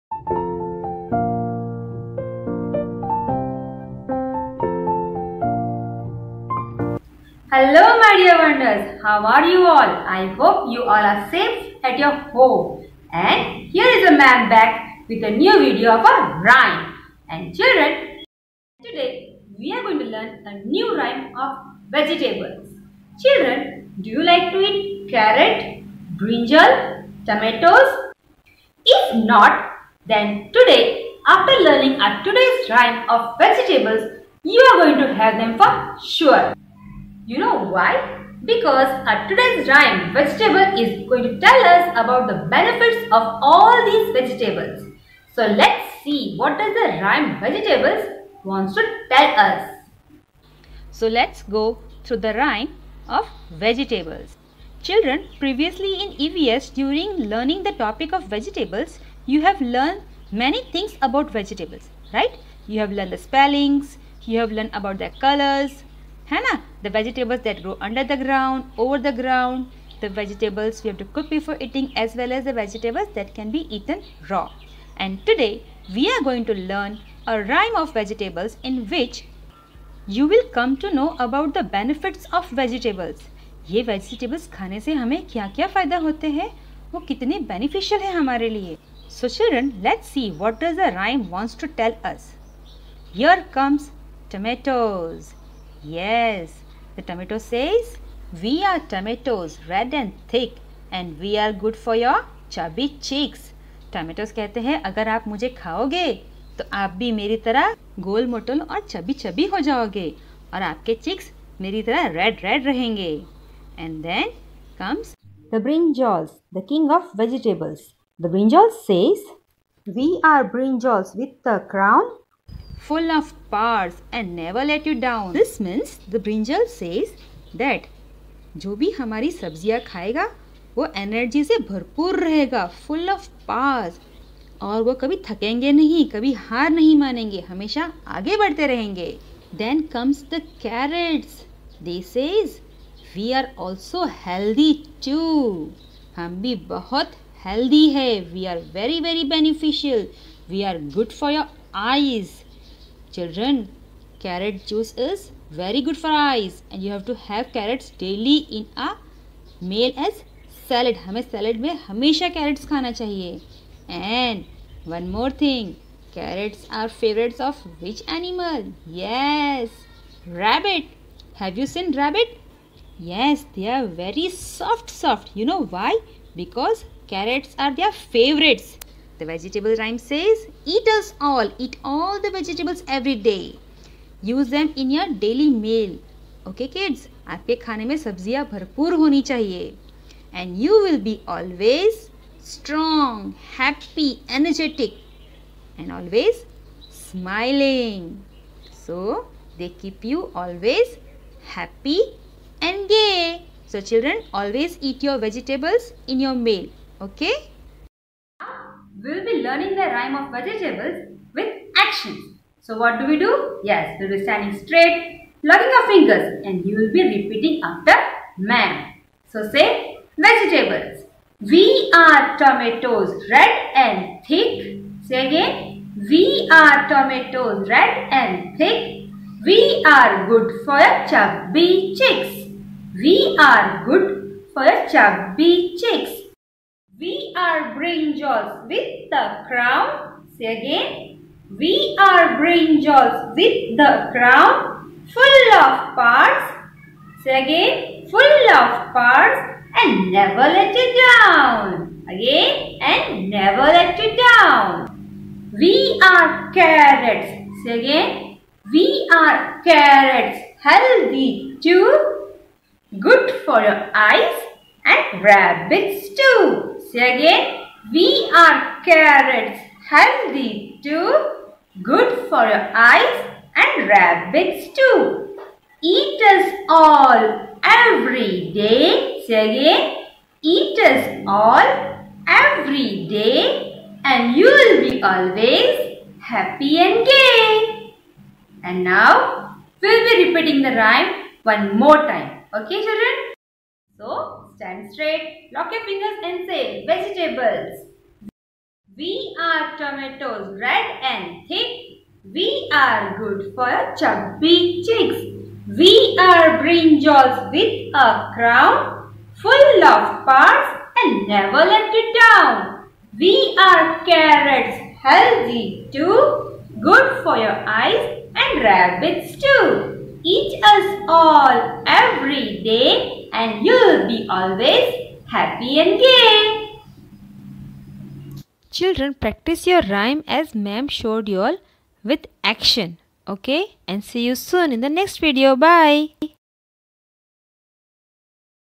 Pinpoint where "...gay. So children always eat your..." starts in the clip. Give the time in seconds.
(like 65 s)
202 s.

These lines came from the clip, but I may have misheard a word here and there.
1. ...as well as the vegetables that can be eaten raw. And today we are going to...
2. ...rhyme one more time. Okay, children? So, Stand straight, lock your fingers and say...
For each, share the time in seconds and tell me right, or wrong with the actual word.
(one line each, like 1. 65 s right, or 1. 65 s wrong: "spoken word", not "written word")
1. 71 s right
2. 290 s right.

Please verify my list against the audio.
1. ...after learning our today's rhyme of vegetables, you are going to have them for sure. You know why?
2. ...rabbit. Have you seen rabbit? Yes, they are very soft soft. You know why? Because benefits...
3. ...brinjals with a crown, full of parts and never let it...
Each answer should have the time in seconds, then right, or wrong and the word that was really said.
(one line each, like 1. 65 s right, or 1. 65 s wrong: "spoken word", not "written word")
1. 31 s right
2. 170 s wrong: "carrots", not "benefits"
3. 306 s right.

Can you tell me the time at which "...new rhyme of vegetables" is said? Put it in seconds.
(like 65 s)
20 s.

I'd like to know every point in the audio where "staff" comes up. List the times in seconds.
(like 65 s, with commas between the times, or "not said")
not said.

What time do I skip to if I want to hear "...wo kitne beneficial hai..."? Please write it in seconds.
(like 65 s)
86 s.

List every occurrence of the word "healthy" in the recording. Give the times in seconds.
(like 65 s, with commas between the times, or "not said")
260 s, 269 s, 315 s.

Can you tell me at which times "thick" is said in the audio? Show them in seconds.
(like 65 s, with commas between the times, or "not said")
100 s, 224 s, 228 s, 301 s.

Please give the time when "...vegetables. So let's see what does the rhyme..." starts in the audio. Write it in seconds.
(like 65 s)
44 s.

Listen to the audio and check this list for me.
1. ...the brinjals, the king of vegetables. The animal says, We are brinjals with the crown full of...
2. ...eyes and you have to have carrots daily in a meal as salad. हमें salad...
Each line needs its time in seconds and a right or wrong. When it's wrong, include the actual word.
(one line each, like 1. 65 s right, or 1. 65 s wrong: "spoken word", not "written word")
1. 115 s wrong: "brinjal", not "animal"
2. 156 s right.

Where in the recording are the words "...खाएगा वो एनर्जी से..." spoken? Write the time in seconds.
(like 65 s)
129 s.